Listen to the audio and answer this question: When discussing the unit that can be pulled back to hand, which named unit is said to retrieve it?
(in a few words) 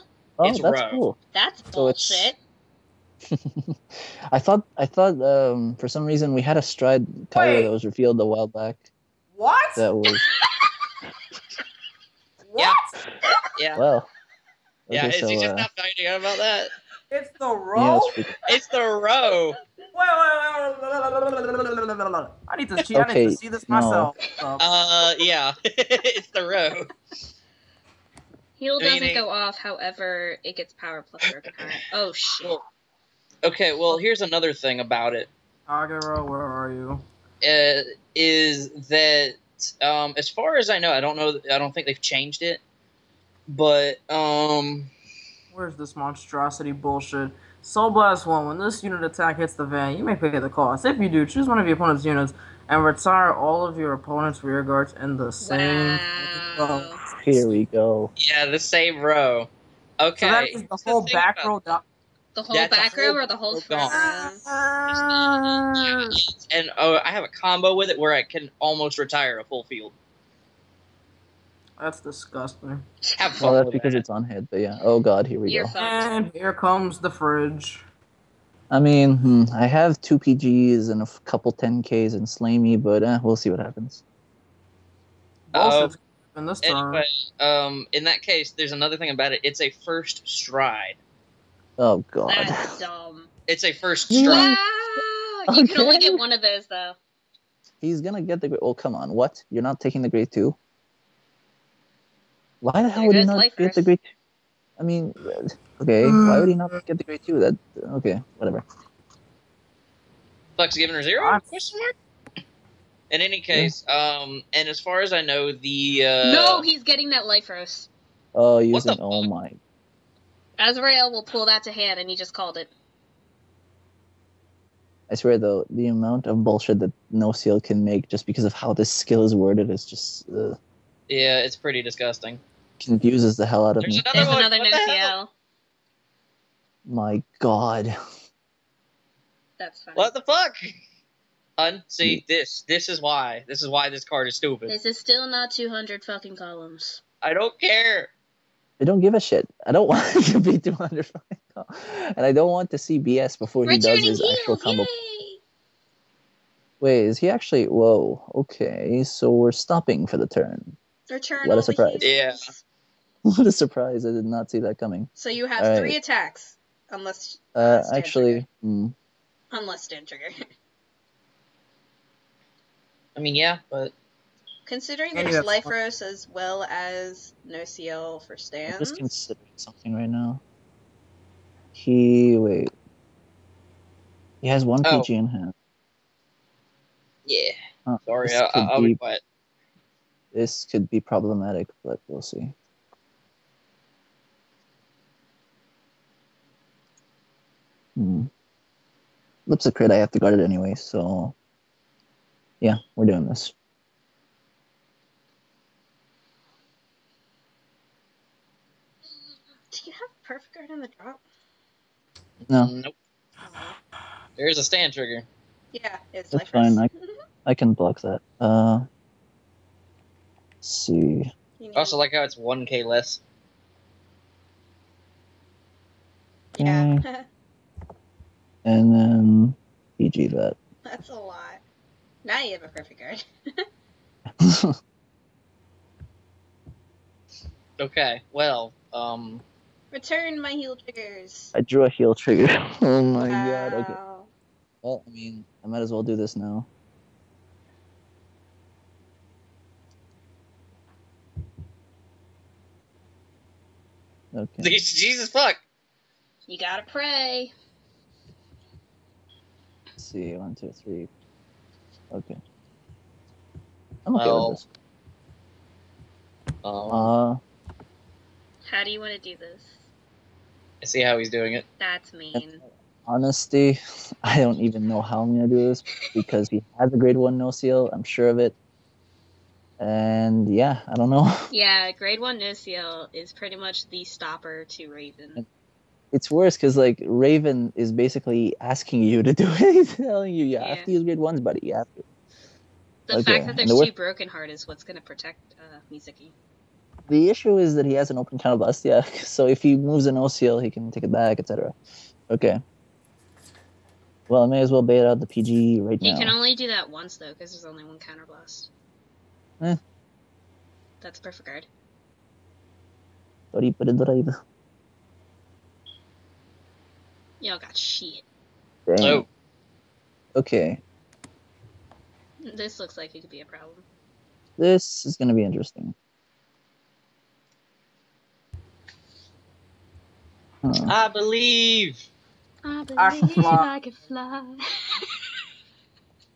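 Azrael.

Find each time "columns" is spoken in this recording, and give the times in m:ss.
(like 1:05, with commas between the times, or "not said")
2:26, 2:31.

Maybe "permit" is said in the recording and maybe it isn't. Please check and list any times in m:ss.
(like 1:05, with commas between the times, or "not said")
not said.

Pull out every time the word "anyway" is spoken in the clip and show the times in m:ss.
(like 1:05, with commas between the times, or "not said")
1:26, 3:20.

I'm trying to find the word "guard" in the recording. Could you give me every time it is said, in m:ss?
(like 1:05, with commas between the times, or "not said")
0:54, 3:20, 3:30, 3:52, 5:11.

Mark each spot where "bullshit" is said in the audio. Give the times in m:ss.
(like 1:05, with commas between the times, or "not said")
0:01, 0:46, 2:06.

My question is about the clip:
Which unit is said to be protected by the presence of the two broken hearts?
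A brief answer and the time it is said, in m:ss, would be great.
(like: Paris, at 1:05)
Mizuki, at 4:55.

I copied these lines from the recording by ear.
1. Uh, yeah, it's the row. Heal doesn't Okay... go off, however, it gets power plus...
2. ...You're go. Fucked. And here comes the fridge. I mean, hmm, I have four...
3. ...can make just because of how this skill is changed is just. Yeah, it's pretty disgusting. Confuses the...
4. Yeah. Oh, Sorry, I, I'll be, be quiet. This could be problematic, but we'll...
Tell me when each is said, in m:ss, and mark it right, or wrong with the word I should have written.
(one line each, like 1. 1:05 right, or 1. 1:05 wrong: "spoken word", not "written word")
1. 0:24 wrong: "Meaning", not "Okay"
2. 1:15 wrong: "two", not "four"
3. 2:07 wrong: "worded", not "changed"
4. 3:07 right.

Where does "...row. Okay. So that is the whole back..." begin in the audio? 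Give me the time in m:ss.
0:58.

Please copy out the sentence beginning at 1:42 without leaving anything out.
Why the hell would he not get the grade?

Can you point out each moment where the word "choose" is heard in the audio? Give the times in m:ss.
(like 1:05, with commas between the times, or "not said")
0:51.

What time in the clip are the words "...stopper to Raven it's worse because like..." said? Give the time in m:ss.
4:44.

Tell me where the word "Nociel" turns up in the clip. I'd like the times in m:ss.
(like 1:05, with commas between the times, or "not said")
2:07, 2:14, 2:57, 4:37, 4:42.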